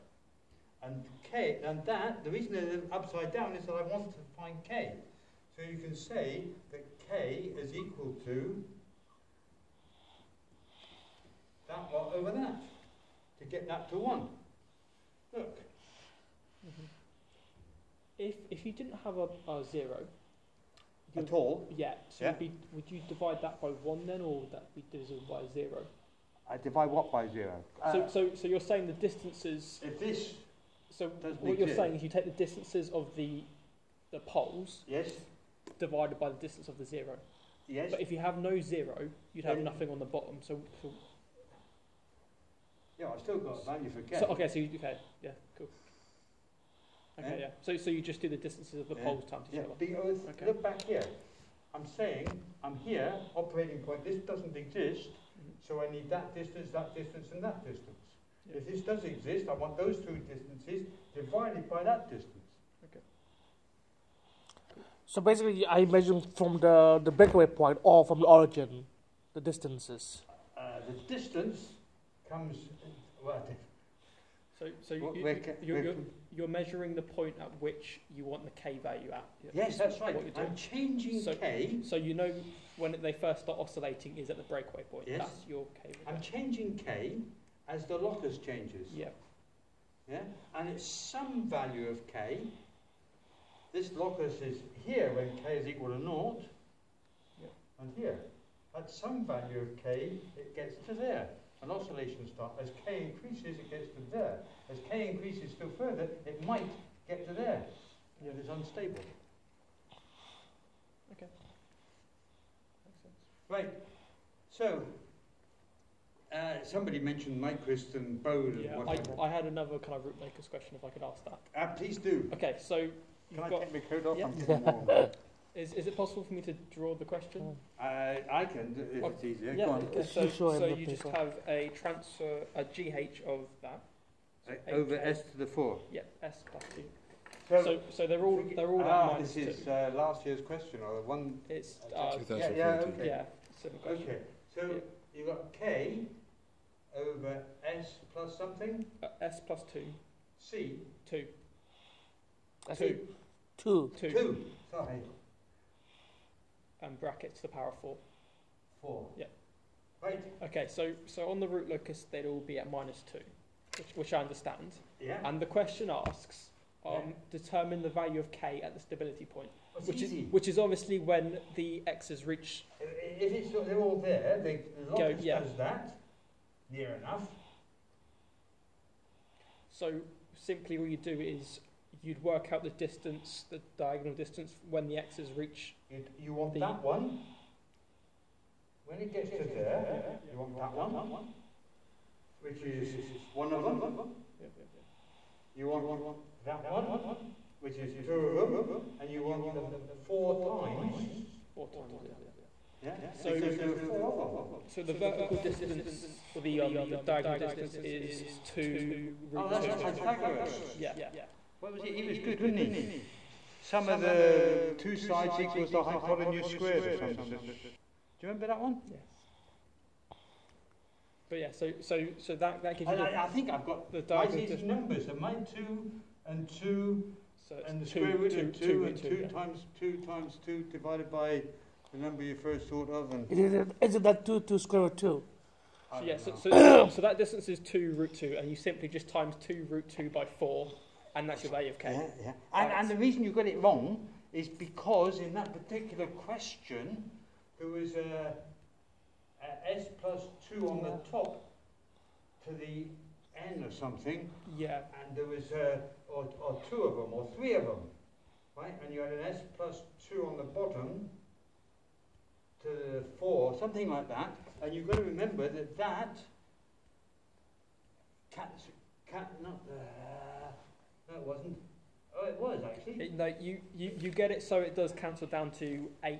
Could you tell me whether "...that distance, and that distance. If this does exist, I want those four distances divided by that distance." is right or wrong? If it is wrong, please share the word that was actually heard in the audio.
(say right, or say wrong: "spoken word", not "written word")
wrong: "two", not "four".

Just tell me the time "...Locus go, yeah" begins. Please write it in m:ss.
2:54.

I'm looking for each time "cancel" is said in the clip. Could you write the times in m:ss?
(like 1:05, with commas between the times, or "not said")
4:34.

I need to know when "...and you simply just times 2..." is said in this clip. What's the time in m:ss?
3:58.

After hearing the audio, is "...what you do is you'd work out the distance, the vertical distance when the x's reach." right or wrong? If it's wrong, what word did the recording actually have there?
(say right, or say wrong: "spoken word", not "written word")
wrong: "diagonal", not "vertical".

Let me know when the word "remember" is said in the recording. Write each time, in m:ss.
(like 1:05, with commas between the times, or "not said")
3:38, 4:25.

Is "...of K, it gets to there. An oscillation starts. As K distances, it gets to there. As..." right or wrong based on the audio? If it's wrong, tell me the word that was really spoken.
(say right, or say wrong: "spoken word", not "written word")
wrong: "increases", not "distances".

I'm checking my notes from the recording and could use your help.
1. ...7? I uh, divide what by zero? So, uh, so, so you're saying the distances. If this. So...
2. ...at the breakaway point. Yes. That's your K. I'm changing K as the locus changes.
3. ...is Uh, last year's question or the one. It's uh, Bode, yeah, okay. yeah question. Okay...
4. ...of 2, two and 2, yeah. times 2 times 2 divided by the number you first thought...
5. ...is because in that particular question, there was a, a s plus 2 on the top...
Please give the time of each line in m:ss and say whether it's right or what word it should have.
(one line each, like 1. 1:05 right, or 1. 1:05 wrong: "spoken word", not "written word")
1. 0:25 wrong: "0", not "7"
2. 1:24 right
3. 2:19 wrong: "Yeah", not "Bode"
4. 3:48 right
5. 4:04 right.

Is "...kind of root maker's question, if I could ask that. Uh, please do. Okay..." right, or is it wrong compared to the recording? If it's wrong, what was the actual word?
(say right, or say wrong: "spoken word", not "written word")
right.